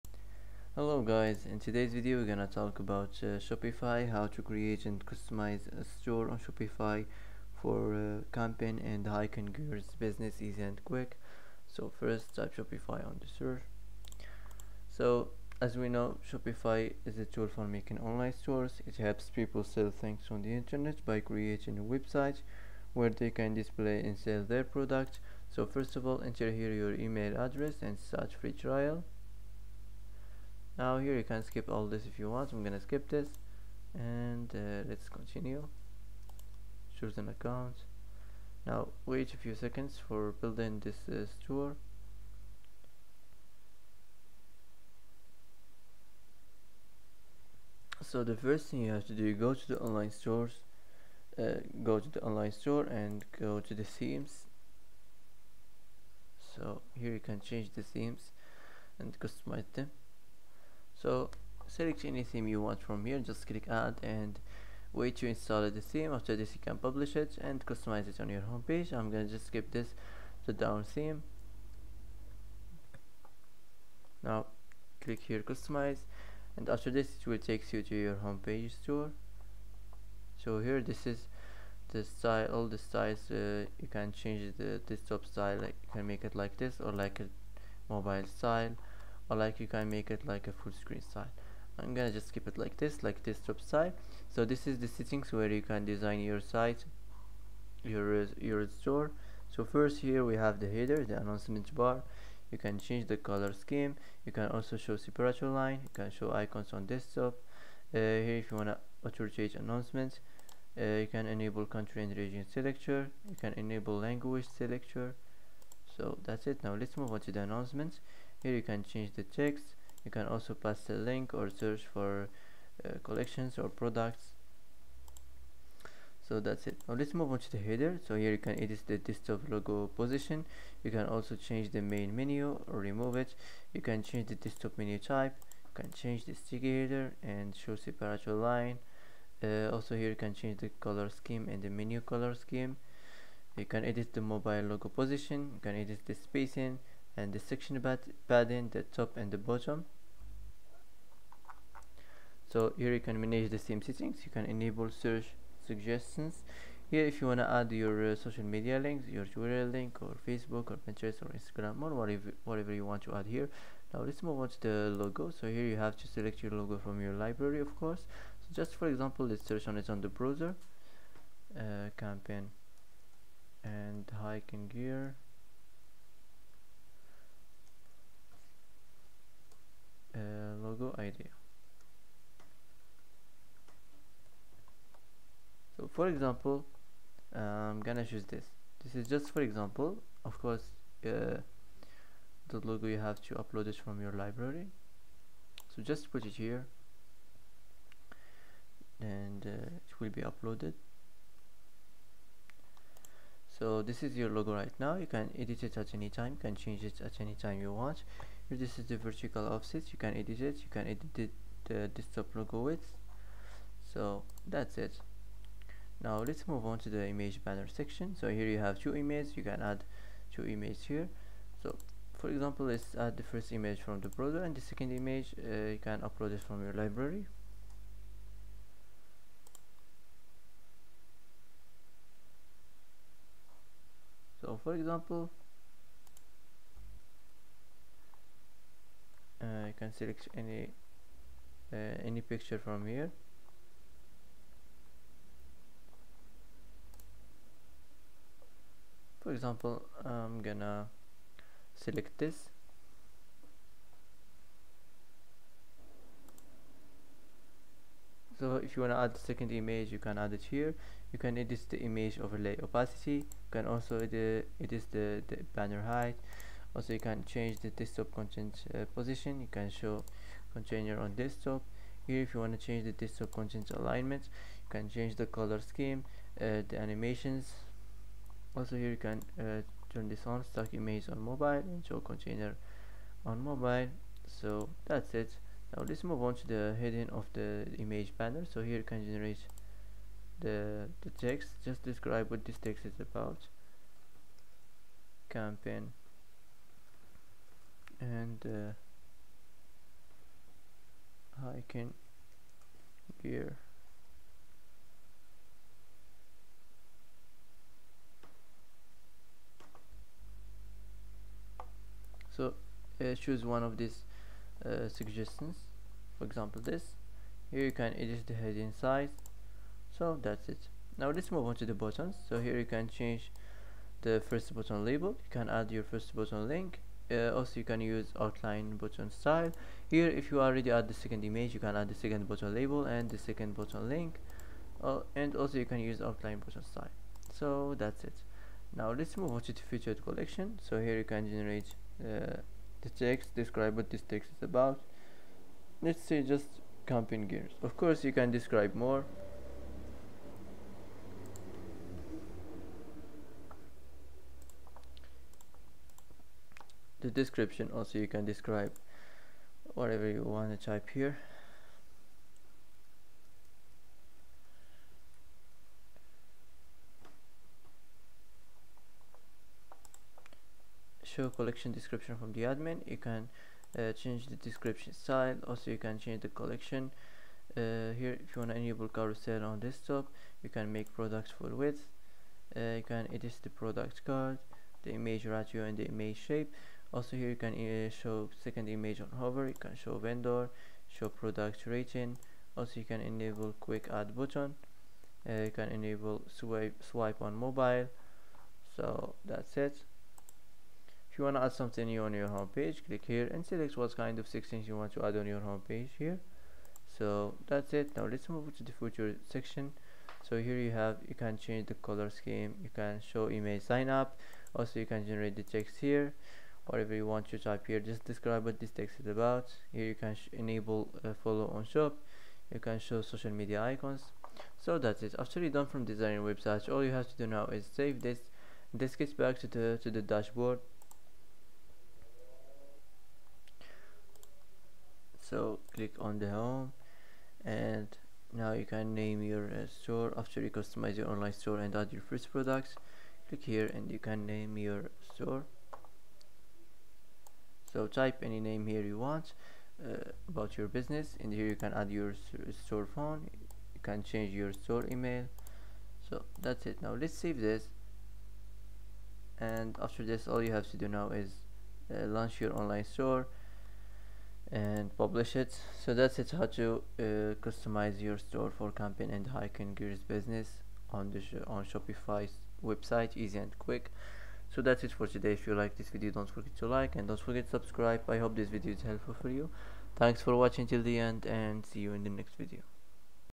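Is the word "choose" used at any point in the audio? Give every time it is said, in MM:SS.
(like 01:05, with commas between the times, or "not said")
00:36, 03:08, 05:13.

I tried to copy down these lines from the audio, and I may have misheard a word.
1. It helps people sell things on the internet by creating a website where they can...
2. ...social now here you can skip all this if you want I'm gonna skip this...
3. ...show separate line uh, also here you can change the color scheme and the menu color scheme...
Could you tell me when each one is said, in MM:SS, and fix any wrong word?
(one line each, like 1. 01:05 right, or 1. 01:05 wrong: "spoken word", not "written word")
1. 00:18 right
2. 00:28 wrong: "trial", not "social"
3. 02:17 right.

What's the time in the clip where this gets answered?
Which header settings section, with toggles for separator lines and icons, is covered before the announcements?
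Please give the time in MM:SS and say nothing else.
01:41.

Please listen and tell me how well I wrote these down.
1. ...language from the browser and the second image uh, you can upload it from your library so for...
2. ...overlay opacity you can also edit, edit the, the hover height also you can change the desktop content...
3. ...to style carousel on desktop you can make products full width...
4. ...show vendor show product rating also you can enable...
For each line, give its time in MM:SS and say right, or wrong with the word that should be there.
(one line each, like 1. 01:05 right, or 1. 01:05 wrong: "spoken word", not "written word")
1. 03:43 wrong: "image", not "language"
2. 04:22 wrong: "banner", not "hover"
3. 06:18 wrong: "enable", not "style"
4. 06:29 right.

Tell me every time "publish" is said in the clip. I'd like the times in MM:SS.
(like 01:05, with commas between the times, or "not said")
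01:06, 07:44.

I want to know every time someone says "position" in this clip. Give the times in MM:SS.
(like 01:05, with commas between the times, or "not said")
02:09, 02:24, 04:28.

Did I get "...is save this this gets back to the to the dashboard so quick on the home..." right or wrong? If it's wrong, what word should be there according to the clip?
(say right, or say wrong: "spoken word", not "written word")
wrong: "click", not "quick".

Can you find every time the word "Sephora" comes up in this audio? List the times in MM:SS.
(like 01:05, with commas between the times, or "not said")
not said.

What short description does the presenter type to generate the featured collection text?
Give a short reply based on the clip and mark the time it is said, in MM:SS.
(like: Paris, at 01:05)
camping gears, at 05:46.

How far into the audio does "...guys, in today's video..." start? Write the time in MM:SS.
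00:01.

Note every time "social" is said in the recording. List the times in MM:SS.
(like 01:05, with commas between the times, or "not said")
02:38, 07:03.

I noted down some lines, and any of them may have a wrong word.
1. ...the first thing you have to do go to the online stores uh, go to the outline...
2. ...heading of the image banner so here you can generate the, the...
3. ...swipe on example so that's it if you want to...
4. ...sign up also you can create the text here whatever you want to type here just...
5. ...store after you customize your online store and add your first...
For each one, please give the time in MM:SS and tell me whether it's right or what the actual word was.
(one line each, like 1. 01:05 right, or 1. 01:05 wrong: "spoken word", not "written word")
1. 00:48 wrong: "online", not "outline"
2. 04:46 right
3. 06:36 wrong: "mobile", not "example"
4. 06:53 wrong: "generate", not "create"
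5. 07:19 right.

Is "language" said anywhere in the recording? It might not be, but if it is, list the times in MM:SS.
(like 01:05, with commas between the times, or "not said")
01:53.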